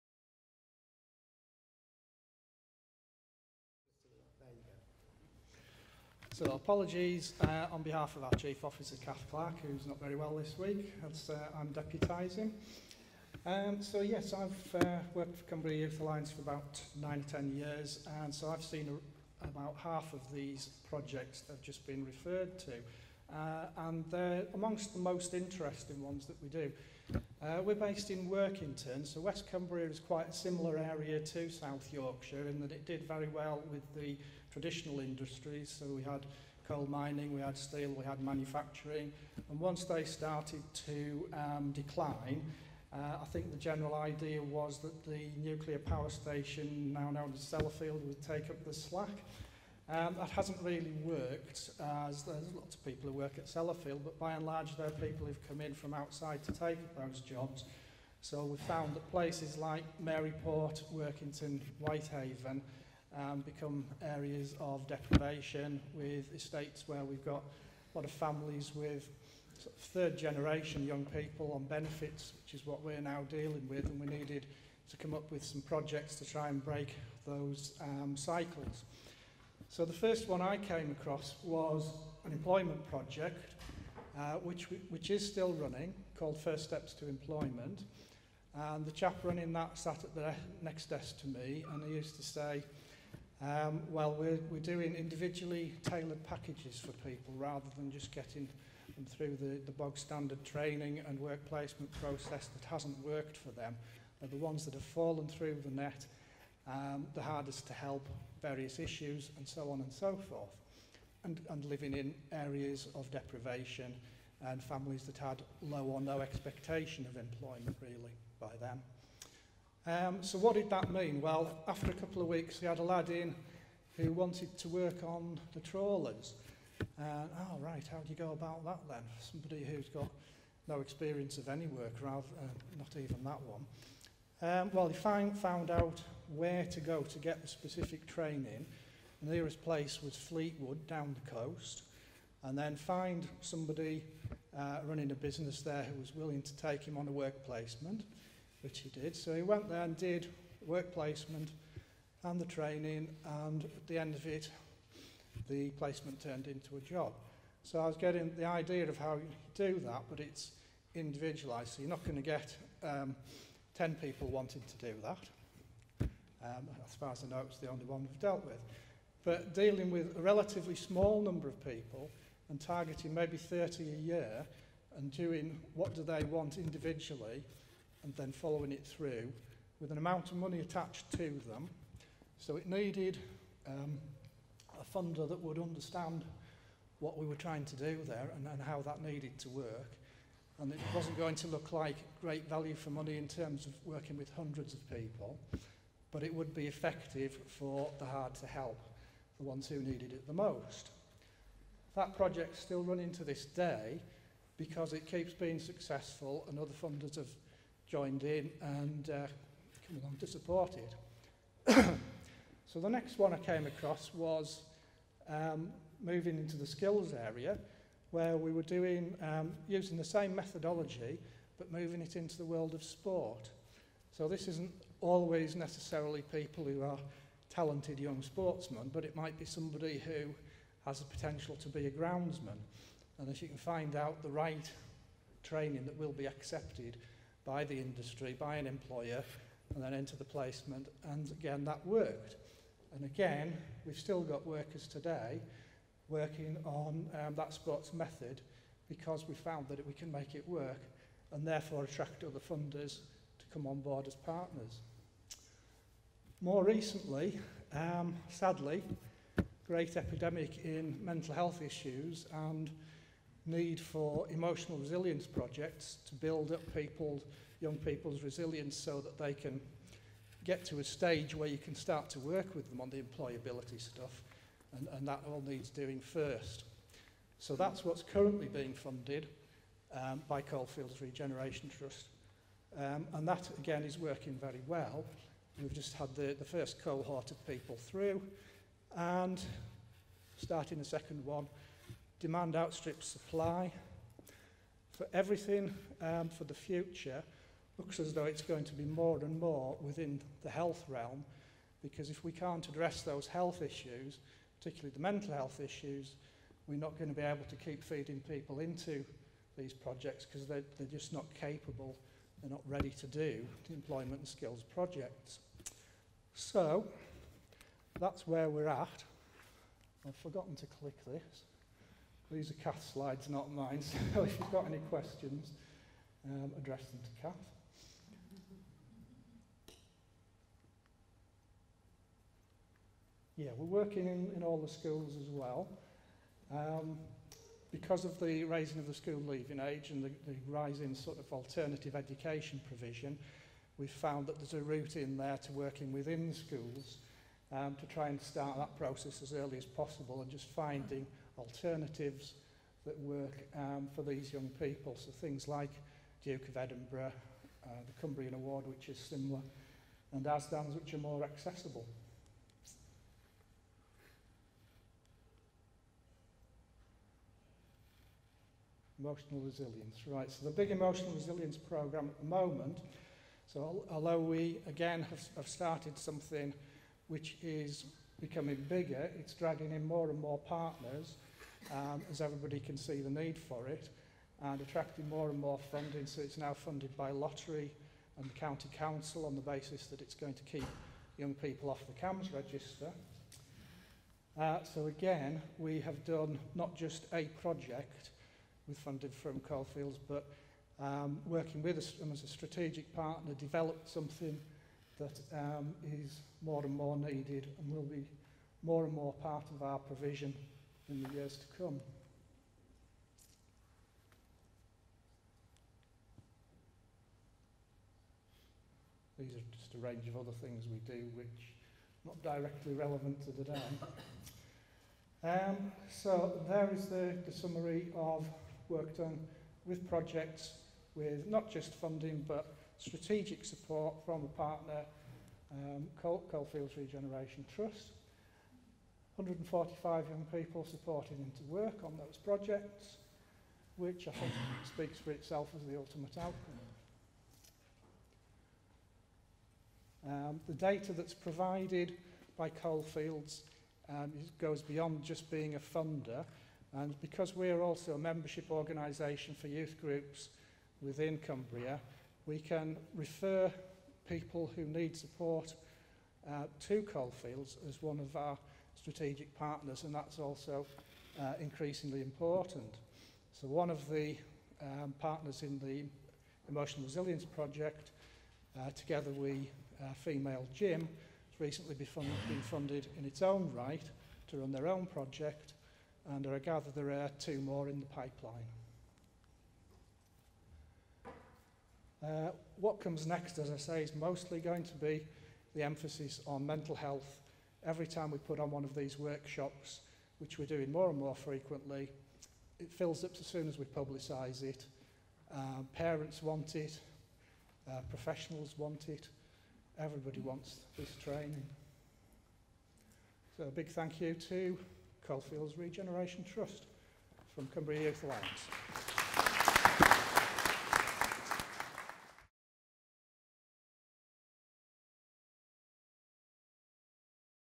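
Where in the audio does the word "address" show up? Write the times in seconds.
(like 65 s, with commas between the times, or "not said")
302 s, 326 s.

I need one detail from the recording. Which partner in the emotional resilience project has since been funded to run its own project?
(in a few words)
Female Gym.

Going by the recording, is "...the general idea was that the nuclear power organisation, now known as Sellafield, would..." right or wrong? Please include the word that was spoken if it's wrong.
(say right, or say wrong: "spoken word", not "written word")
wrong: "station", not "organisation".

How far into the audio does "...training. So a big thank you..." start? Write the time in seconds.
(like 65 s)
511 s.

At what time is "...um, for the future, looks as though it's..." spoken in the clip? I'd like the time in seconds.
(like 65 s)
296 s.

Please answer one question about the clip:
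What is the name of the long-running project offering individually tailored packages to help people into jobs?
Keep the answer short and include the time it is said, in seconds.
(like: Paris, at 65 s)
First Steps to Employment, at 86 s.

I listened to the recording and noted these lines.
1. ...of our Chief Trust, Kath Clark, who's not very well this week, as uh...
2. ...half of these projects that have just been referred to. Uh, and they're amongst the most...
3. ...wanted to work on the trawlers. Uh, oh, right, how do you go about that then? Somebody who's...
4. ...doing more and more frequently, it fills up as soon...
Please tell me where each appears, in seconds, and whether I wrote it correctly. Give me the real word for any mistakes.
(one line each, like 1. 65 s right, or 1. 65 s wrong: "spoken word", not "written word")
1. 8 s wrong: "Officer", not "Trust"
2. 19 s right
3. 124 s right
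4. 500 s right.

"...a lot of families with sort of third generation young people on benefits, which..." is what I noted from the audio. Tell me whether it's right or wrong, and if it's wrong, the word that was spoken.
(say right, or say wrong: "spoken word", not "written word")
right.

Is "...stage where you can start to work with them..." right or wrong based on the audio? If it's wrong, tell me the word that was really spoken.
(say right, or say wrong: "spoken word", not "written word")
right.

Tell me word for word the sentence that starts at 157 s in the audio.
So I was getting the idea of how you do that, but it's individualized.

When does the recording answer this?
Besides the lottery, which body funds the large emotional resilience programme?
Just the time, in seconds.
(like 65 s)
388 s.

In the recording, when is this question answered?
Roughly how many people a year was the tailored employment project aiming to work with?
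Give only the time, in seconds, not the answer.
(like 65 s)
173 s.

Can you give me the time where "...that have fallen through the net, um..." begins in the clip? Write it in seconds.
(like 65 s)
104 s.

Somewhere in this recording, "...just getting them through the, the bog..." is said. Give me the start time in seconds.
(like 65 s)
97 s.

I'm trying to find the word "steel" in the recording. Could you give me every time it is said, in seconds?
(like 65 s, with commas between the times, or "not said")
37 s.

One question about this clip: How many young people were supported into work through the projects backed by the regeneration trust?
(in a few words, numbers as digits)
145.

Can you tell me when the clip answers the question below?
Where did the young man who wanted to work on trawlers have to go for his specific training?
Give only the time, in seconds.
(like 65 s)
140 s.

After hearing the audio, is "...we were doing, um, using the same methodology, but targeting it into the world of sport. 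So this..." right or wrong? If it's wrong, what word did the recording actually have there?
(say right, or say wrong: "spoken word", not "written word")
wrong: "moving", not "targeting".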